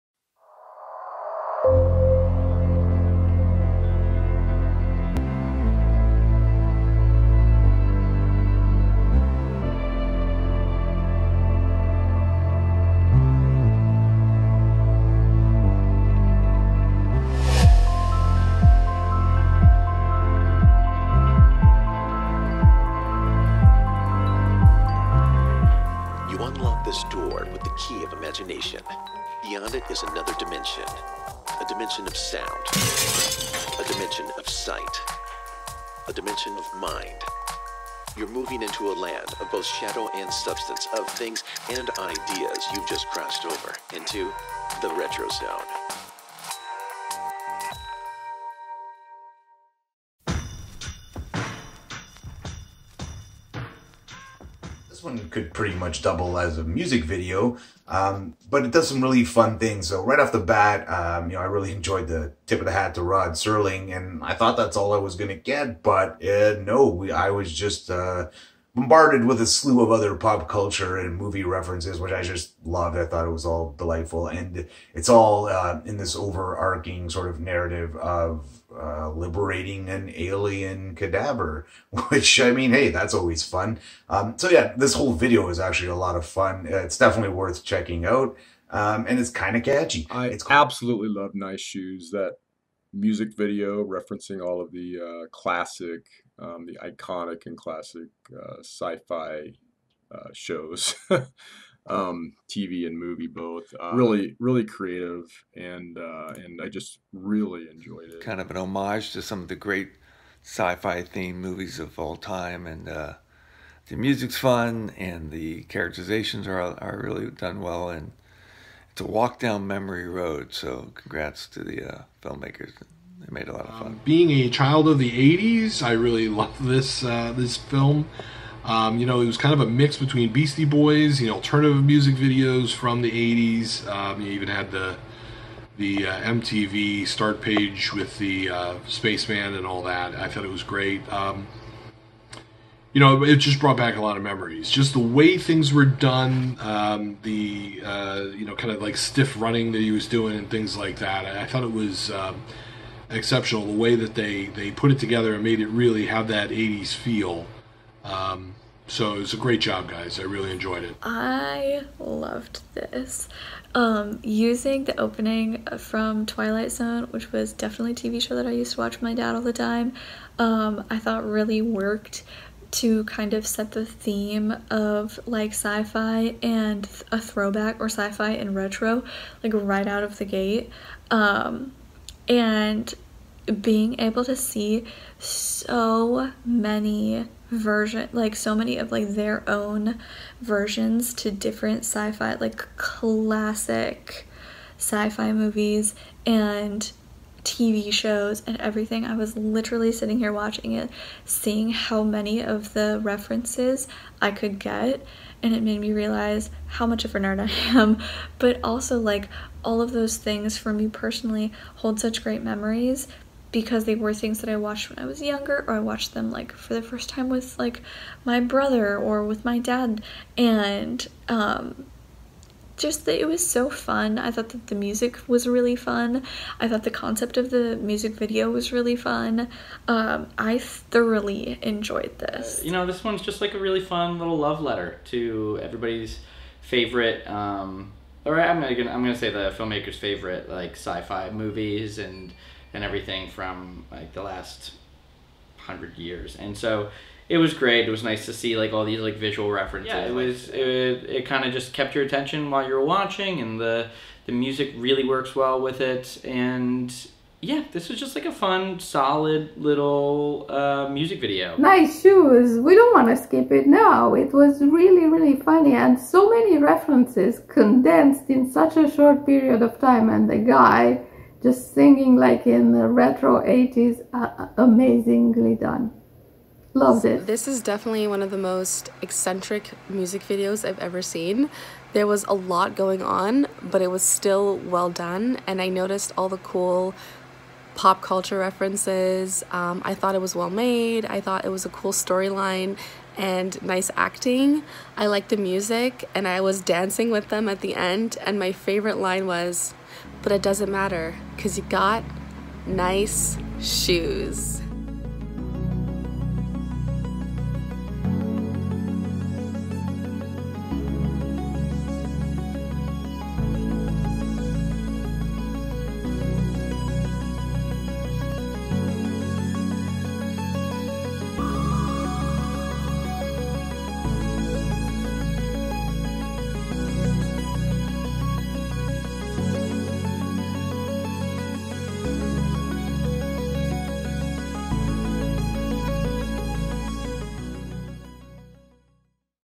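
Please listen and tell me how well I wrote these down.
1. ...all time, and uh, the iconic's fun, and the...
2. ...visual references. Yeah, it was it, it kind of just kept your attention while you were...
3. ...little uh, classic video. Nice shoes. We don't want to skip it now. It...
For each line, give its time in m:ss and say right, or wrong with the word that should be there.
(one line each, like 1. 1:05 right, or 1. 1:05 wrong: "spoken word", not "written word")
1. 1:51 wrong: "music", not "iconic"
2. 4:09 right
3. 4:19 wrong: "music", not "classic".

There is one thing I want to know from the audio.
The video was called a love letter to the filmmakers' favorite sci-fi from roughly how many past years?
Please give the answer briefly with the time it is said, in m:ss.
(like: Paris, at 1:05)
100, at 4:05.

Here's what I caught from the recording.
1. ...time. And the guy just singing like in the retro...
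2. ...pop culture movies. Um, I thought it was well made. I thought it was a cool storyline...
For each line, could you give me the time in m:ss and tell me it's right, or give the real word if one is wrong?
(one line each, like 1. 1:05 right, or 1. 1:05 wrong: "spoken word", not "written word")
1. 4:29 right
2. 4:47 wrong: "references", not "movies".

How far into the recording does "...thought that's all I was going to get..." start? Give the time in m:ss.
1:04.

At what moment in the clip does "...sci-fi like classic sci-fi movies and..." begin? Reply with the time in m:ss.
3:11.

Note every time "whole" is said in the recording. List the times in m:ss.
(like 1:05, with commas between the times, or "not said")
1:24.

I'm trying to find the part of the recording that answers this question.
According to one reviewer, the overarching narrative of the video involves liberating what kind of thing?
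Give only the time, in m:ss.
1:20.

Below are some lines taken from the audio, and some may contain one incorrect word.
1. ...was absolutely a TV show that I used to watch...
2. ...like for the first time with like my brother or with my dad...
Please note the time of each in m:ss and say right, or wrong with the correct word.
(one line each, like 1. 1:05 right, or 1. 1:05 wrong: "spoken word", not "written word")
1. 2:47 wrong: "definitely", not "absolutely"
2. 3:36 right.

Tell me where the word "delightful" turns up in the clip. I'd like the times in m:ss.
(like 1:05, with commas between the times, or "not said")
1:13.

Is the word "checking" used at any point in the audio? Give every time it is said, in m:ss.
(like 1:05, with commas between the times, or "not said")
1:27.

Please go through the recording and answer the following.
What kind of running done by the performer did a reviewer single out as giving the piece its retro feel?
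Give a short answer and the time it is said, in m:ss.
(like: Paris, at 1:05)
Stiff running, at 2:28.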